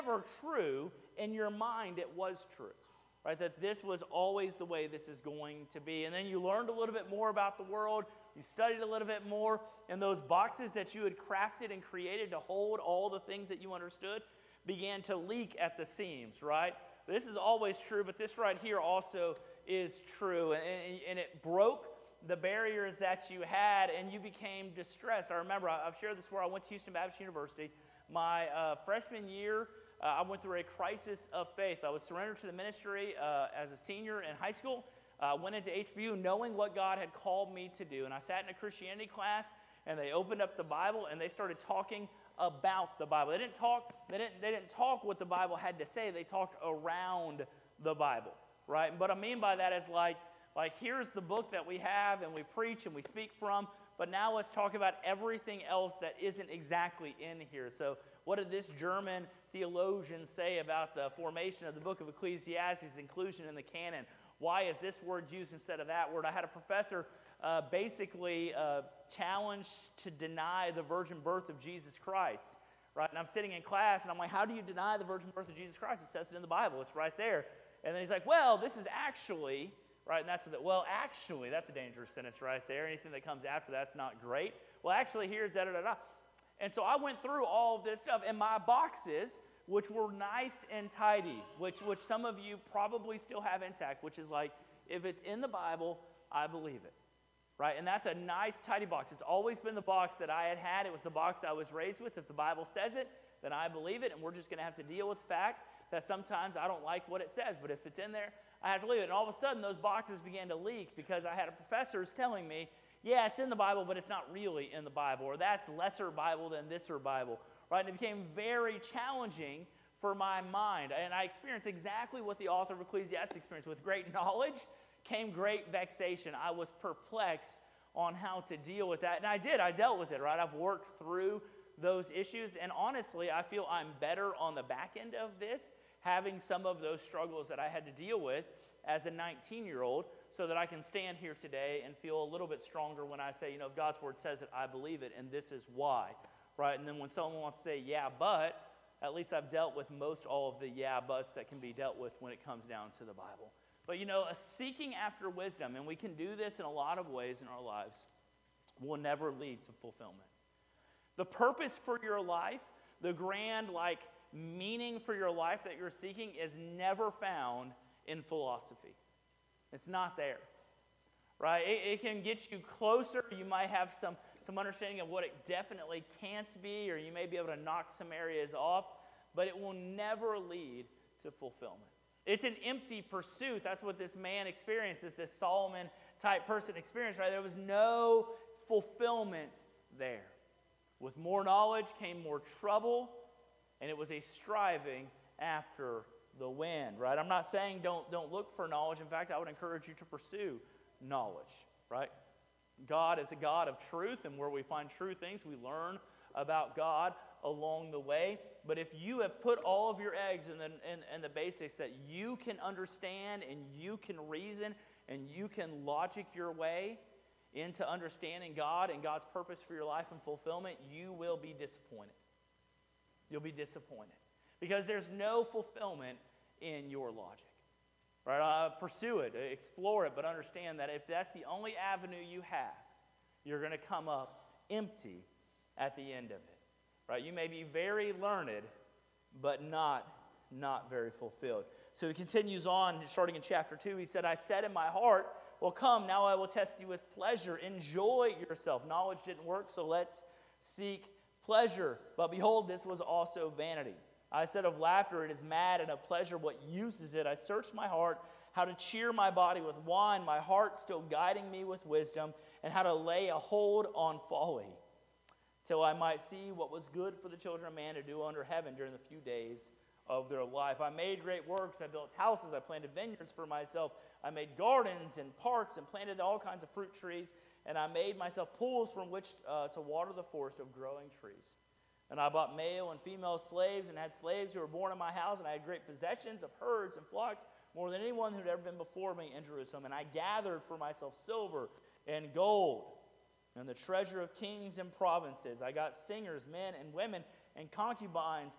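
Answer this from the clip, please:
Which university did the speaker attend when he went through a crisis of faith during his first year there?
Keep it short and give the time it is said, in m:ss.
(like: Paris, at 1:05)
Houston Baptist University, at 0:26.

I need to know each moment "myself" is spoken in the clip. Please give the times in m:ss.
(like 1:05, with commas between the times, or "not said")
4:33, 4:38, 4:50.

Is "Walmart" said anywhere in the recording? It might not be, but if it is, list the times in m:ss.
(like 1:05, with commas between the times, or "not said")
not said.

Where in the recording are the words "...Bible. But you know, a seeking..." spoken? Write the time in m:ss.
2:33.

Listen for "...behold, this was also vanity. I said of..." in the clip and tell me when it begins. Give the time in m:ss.
4:12.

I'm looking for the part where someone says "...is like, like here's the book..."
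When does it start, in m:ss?
0:49.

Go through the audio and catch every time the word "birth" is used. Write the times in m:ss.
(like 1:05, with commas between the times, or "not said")
1:11, 1:15.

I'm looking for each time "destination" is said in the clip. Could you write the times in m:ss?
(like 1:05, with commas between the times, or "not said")
not said.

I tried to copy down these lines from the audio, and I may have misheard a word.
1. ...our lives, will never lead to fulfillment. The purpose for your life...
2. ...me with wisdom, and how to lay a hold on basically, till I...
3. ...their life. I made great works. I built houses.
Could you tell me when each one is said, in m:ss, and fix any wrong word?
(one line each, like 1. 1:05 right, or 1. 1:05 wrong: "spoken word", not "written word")
1. 2:37 right
2. 4:21 wrong: "folly", not "basically"
3. 4:30 right.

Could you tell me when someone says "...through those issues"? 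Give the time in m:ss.
2:10.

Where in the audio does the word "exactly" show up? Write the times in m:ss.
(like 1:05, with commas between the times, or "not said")
0:56, 2:01.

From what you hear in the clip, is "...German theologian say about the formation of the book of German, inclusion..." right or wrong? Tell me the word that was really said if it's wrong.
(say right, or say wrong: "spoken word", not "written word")
wrong: "Ecclesiastes", not "German".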